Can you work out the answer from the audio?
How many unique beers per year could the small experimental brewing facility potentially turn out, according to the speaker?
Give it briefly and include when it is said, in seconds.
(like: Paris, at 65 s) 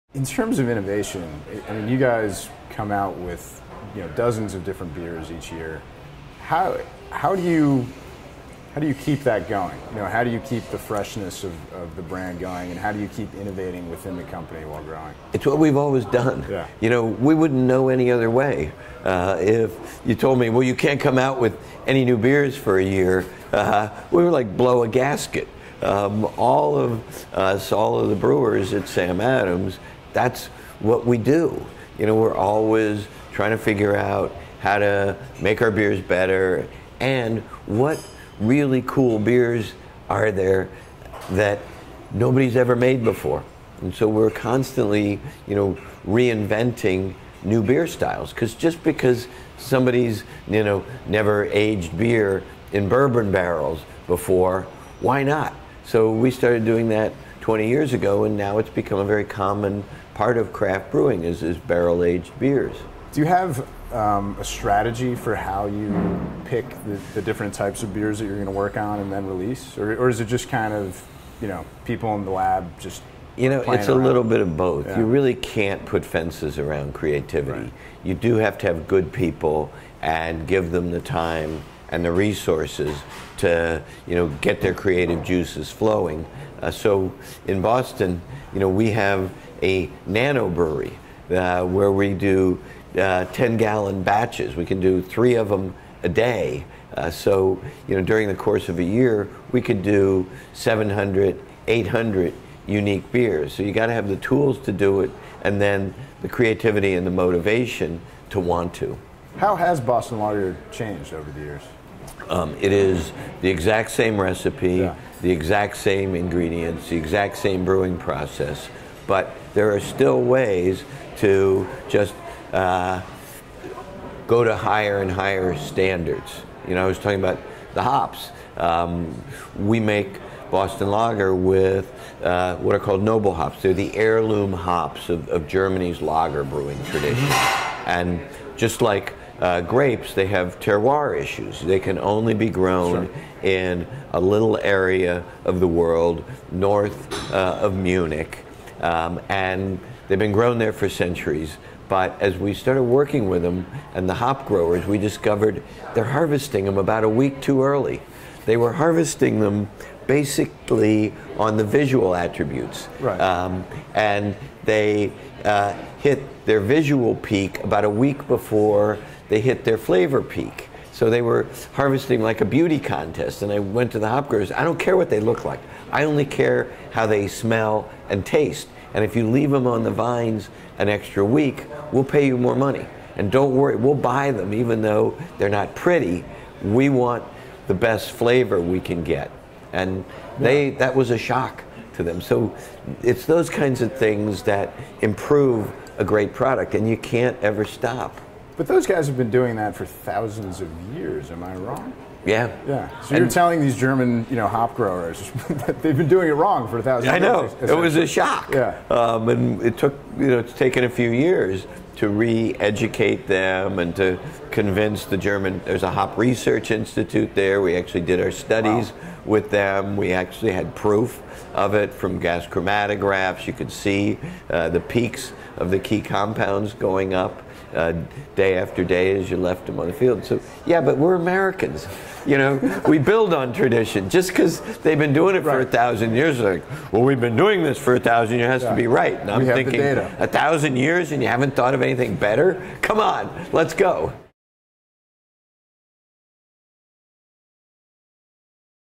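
700 to 800, at 100 s.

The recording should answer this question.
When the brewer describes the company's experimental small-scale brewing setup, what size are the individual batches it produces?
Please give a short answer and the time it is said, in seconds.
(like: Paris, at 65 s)
10 gallons, at 93 s.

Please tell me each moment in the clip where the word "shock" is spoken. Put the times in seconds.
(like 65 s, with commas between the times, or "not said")
191 s, 208 s.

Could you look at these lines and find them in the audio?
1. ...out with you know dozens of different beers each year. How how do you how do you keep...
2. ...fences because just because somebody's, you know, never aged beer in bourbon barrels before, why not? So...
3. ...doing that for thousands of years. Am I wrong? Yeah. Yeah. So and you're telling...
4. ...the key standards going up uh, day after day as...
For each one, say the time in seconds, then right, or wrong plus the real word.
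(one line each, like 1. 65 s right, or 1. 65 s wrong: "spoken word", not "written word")
1. 2 s right
2. 47 s wrong: "styles", not "fences"
3. 199 s right
4. 225 s wrong: "compounds", not "standards".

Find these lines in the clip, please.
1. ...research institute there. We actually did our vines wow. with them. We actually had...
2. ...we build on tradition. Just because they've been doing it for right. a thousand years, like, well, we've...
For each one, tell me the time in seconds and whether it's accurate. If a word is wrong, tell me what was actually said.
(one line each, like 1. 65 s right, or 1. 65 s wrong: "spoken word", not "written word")
1. 216 s wrong: "studies", not "vines"
2. 232 s right.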